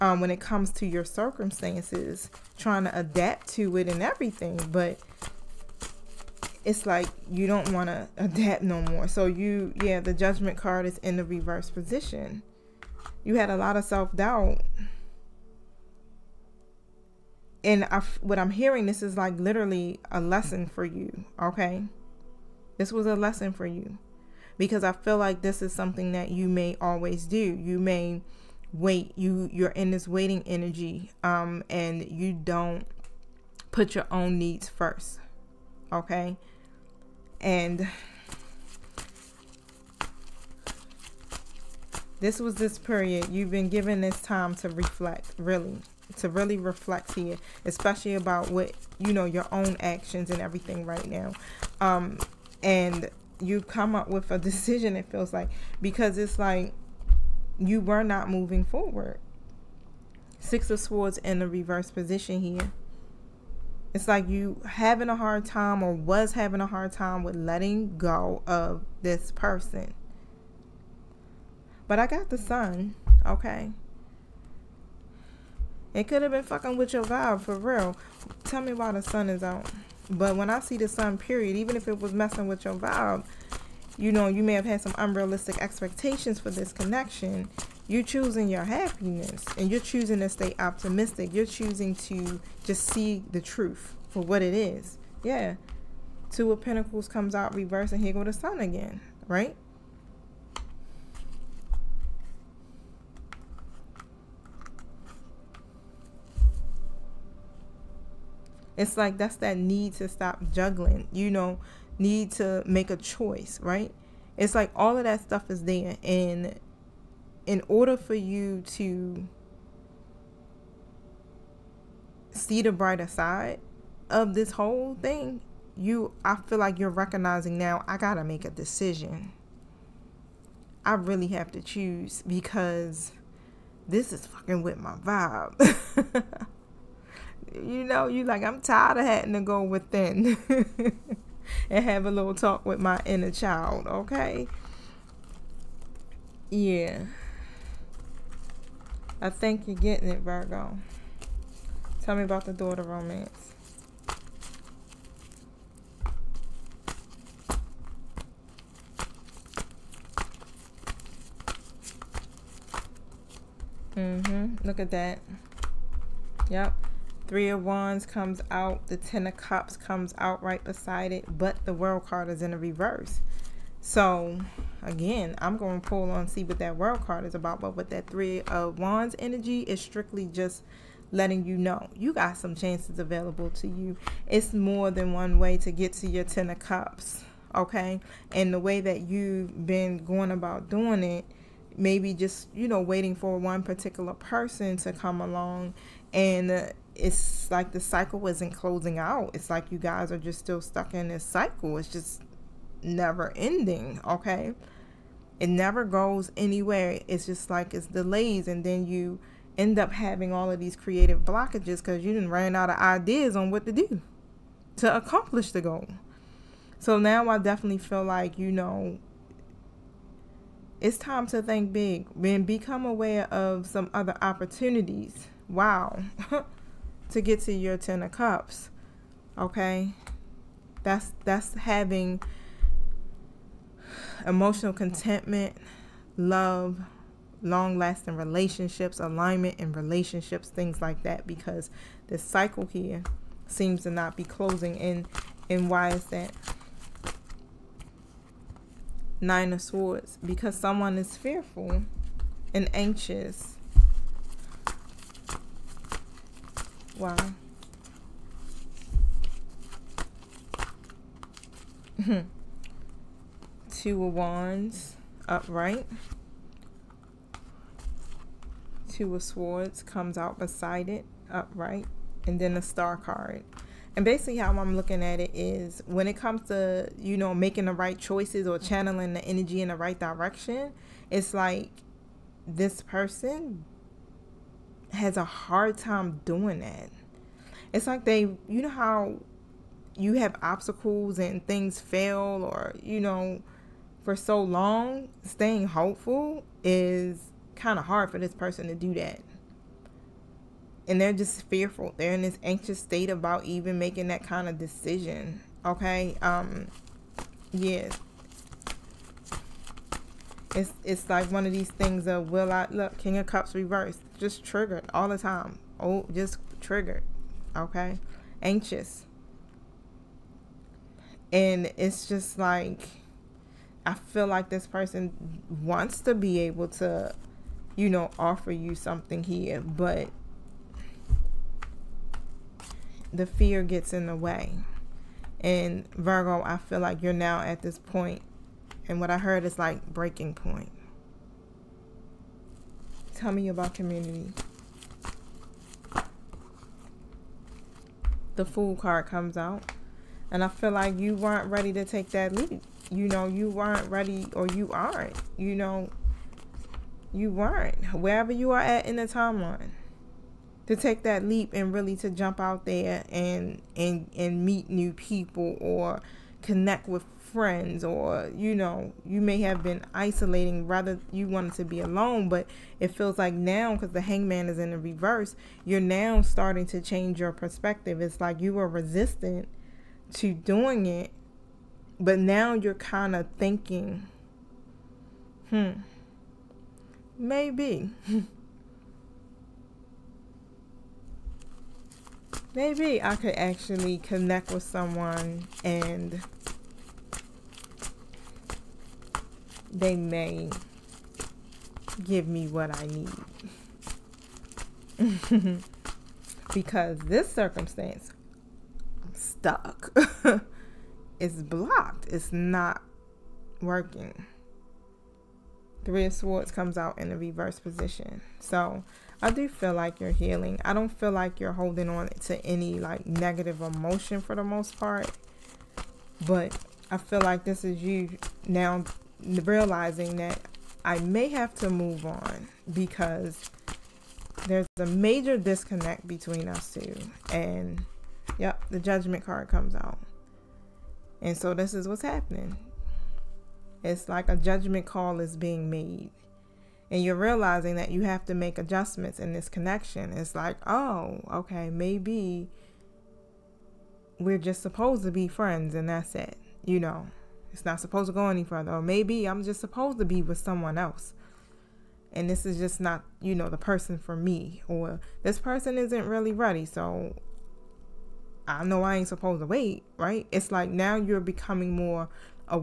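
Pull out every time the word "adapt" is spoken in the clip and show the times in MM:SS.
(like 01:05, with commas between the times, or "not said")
00:02, 00:08.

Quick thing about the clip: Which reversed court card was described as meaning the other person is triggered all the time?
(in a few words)
King of Cups.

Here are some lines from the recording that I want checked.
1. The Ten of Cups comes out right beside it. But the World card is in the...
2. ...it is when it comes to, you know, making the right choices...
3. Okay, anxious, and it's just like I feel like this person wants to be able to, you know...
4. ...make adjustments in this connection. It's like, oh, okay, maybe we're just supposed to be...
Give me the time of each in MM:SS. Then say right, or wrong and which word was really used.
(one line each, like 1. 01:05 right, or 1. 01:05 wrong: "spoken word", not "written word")
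1. 02:48 right
2. 04:35 right
3. 05:17 right
4. 07:28 right.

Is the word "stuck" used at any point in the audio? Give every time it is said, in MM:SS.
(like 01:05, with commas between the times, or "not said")
03:20, 06:49.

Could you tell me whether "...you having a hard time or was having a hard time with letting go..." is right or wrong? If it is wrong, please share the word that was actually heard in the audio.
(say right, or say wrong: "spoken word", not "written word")
right.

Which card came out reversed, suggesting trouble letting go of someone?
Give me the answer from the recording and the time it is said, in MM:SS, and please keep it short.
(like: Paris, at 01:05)
Six of Swords, at 01:00.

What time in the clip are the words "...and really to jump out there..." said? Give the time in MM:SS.
06:01.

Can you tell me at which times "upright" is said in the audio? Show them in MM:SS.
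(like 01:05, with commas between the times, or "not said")
04:25, 04:31.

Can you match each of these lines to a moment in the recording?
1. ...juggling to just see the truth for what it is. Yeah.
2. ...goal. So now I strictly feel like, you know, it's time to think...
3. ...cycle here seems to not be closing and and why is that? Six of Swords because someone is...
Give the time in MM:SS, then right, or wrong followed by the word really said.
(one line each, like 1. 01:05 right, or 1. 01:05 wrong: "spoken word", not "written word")
1. 01:31 wrong: "choosing", not "juggling"
2. 03:35 wrong: "definitely", not "strictly"
3. 04:02 wrong: "Nine", not "Six".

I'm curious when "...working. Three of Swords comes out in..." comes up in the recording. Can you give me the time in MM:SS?
06:53.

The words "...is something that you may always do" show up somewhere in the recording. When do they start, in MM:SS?
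00:25.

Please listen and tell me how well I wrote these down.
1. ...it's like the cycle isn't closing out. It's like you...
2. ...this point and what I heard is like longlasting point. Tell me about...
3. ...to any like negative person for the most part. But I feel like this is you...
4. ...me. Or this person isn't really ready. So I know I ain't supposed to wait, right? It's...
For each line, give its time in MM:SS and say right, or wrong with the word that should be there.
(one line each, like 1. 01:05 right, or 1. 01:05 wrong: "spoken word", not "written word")
1. 03:16 right
2. 05:37 wrong: "breaking", not "longlasting"
3. 07:02 wrong: "emotion", not "person"
4. 07:44 right.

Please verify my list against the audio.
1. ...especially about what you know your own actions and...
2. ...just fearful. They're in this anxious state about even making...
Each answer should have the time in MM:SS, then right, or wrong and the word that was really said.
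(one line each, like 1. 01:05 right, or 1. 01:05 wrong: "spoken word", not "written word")
1. 00:47 right
2. 05:01 right.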